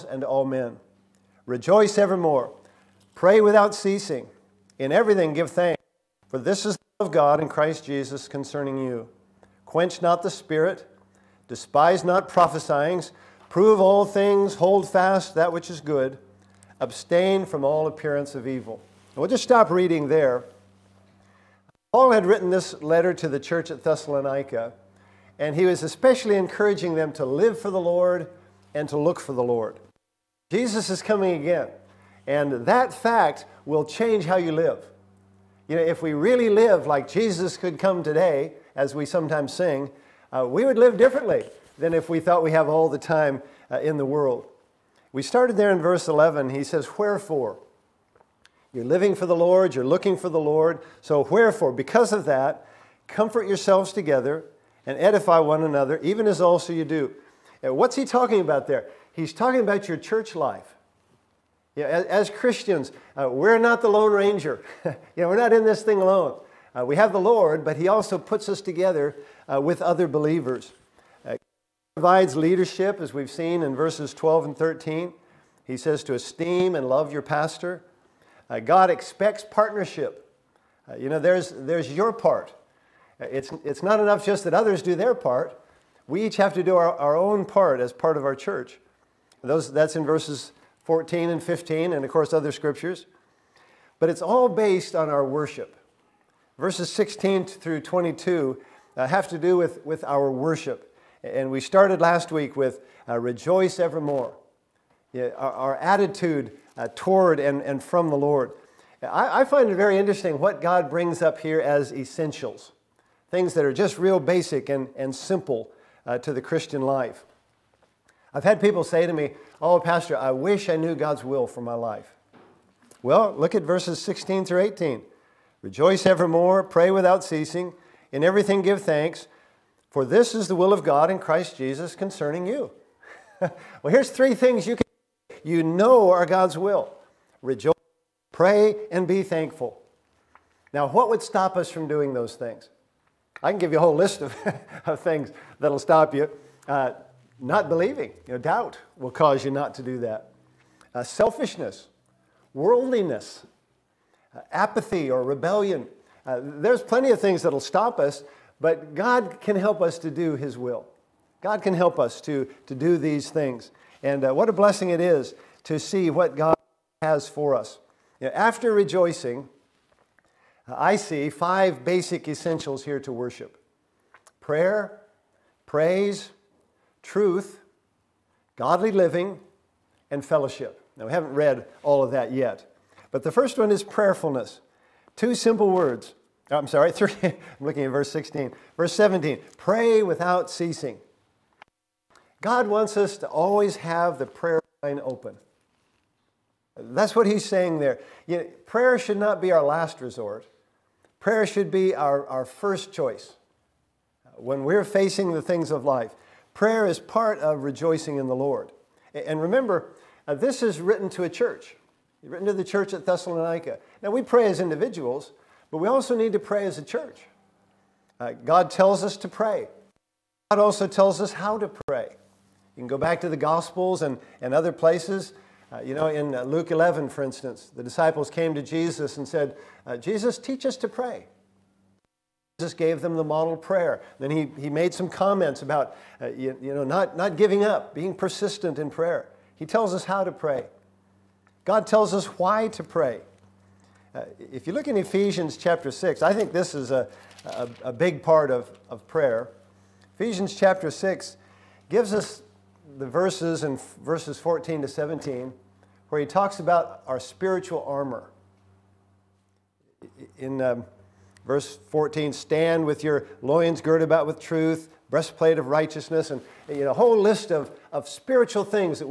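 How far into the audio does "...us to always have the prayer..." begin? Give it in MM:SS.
03:12.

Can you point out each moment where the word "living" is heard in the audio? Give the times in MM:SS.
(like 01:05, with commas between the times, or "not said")
00:48, 02:58.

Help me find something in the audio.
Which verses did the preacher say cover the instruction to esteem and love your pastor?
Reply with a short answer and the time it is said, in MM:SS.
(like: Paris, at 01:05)
12 and 13, at 01:13.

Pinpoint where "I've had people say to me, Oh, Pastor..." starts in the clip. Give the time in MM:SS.
01:58.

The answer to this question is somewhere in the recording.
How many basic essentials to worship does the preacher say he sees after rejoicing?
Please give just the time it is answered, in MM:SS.
02:51.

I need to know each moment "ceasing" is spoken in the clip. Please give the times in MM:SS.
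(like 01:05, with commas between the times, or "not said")
00:03, 02:07, 03:10.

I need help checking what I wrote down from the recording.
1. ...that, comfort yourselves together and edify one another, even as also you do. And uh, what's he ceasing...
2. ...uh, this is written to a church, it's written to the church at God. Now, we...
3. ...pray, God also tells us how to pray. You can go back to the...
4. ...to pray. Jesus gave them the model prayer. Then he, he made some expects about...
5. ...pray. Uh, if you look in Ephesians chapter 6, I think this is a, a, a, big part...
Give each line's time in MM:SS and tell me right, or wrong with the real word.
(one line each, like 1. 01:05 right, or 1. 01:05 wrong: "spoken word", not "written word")
1. 00:52 wrong: "talking", not "ceasing"
2. 03:30 wrong: "Thessalonica", not "God"
3. 03:39 right
4. 03:50 wrong: "comments", not "expects"
5. 04:02 right.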